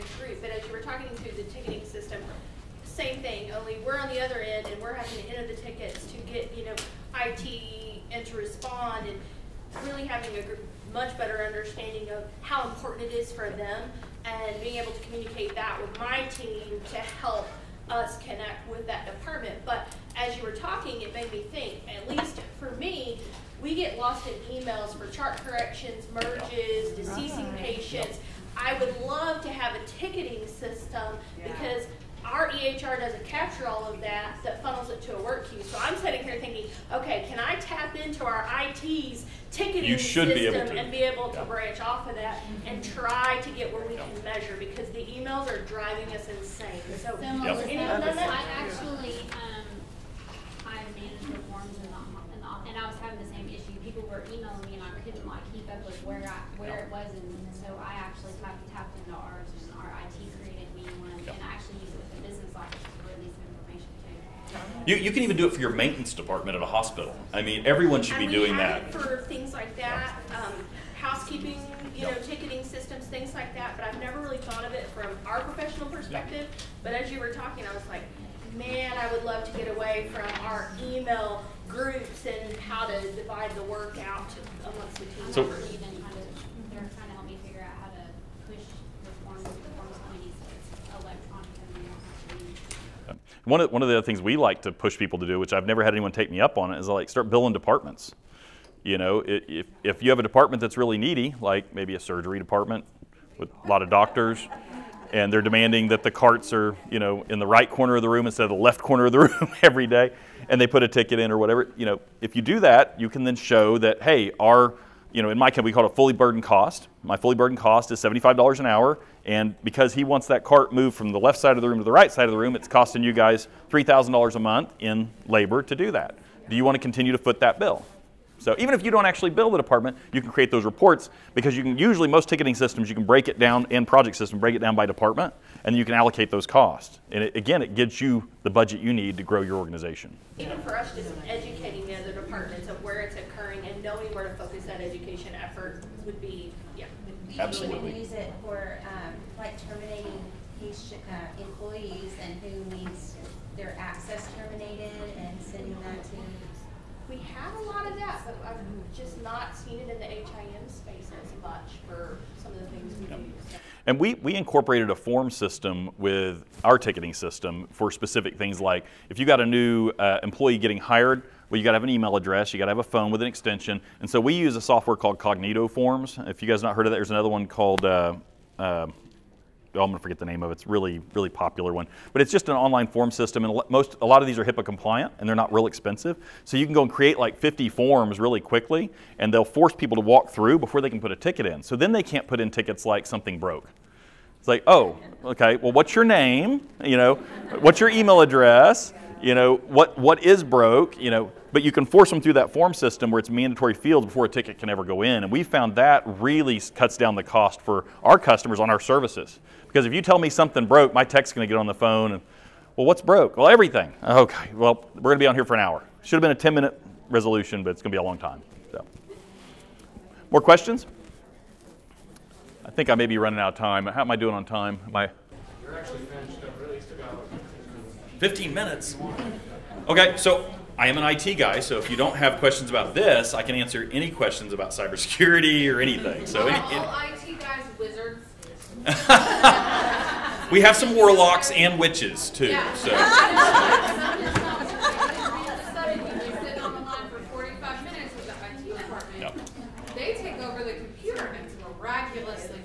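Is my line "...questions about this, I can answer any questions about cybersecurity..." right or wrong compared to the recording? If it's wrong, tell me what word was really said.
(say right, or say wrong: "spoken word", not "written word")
right.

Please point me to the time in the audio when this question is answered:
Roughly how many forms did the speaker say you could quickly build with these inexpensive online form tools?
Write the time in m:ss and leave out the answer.
3:07.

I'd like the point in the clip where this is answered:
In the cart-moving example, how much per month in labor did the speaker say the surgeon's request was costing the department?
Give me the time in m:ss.
2:03.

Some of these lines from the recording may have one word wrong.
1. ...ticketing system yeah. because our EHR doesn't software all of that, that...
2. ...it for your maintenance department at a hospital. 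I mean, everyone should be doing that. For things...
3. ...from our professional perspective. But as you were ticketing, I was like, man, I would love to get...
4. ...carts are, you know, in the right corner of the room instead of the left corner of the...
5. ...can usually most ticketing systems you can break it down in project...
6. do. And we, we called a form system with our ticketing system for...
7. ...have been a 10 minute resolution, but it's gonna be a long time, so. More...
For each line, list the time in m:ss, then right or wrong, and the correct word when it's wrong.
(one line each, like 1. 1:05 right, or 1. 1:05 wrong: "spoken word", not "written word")
1. 0:29 wrong: "capture", not "software"
2. 1:05 right
3. 1:14 wrong: "talking", not "ticketing"
4. 1:46 right
5. 2:11 right
6. 2:43 wrong: "incorporated", not "called"
7. 3:36 right.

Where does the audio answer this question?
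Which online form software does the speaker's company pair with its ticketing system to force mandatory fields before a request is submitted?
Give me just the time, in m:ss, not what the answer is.
2:55.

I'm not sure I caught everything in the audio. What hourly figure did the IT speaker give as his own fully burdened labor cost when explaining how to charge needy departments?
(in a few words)
$75 an hour.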